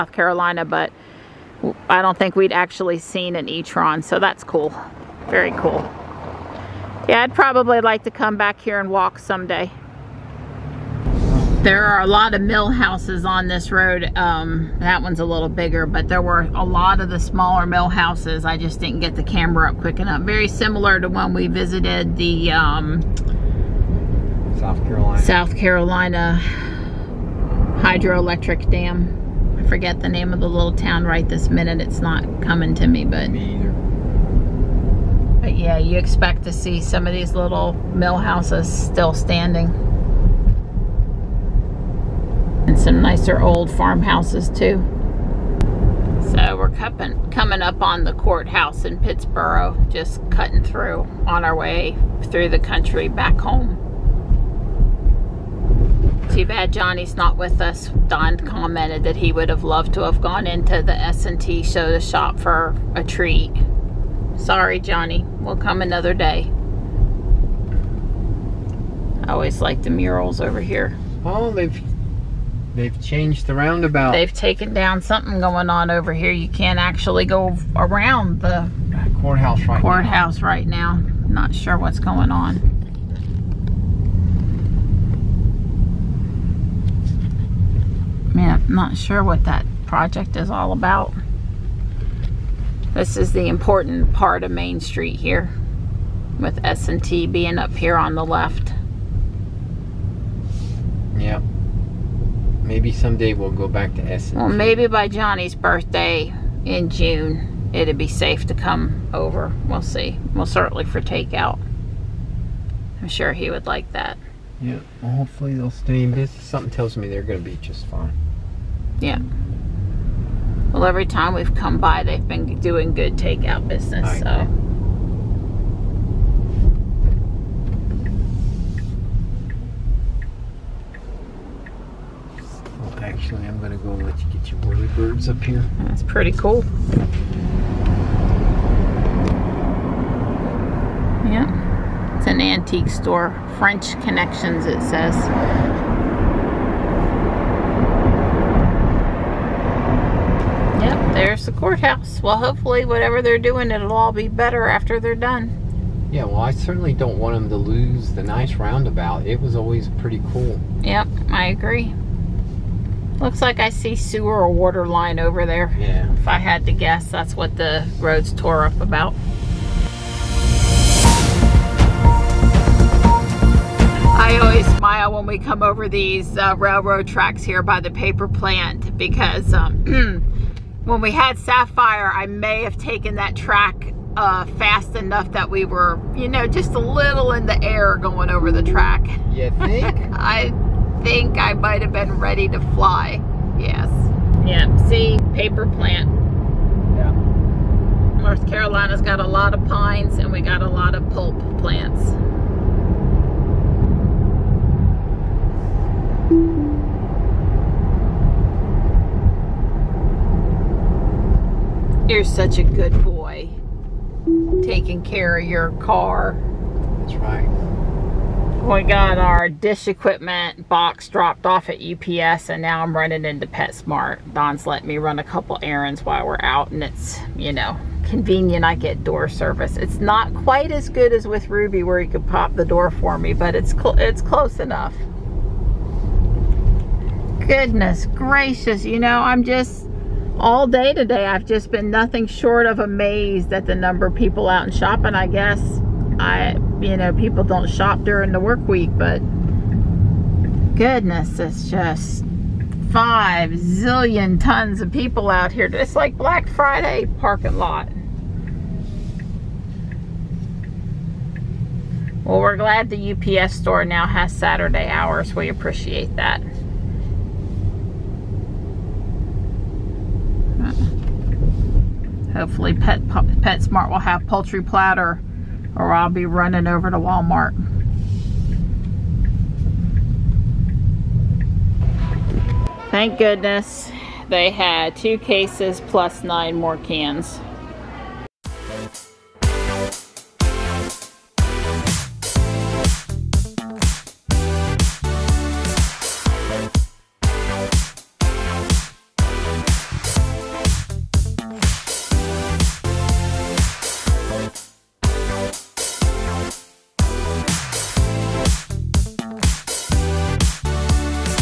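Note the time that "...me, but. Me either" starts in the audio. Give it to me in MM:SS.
00:32.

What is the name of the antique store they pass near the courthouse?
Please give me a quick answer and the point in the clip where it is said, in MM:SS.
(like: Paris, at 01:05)
French Connections, at 02:23.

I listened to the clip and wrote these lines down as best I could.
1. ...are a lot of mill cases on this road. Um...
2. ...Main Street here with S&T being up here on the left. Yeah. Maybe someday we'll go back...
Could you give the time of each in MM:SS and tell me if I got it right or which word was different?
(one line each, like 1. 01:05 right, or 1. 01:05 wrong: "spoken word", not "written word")
1. 00:11 wrong: "houses", not "cases"
2. 01:34 right.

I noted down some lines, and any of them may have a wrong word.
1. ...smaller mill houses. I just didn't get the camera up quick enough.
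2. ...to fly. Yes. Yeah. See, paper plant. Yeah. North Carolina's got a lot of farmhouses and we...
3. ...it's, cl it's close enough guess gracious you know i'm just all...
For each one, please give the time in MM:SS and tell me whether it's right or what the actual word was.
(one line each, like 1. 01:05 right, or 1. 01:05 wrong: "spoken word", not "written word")
1. 00:17 right
2. 03:12 wrong: "pines", not "farmhouses"
3. 03:53 wrong: "goodness", not "guess".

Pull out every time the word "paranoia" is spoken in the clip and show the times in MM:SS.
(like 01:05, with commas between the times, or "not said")
not said.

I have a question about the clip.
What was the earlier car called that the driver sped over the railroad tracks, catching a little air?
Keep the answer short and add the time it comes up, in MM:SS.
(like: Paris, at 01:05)
Sapphire, at 03:01.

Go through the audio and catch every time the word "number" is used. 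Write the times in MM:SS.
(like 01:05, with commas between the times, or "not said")
04:03.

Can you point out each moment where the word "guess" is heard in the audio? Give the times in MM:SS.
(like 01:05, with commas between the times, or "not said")
02:46, 04:05.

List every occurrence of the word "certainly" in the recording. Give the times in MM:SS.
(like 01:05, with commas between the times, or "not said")
01:50, 02:36.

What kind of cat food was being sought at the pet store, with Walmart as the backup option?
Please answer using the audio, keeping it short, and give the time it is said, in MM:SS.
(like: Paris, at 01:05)
Poultry platter, at 04:34.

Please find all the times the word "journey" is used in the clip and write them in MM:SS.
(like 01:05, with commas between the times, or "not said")
not said.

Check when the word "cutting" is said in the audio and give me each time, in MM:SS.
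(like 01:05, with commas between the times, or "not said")
00:50.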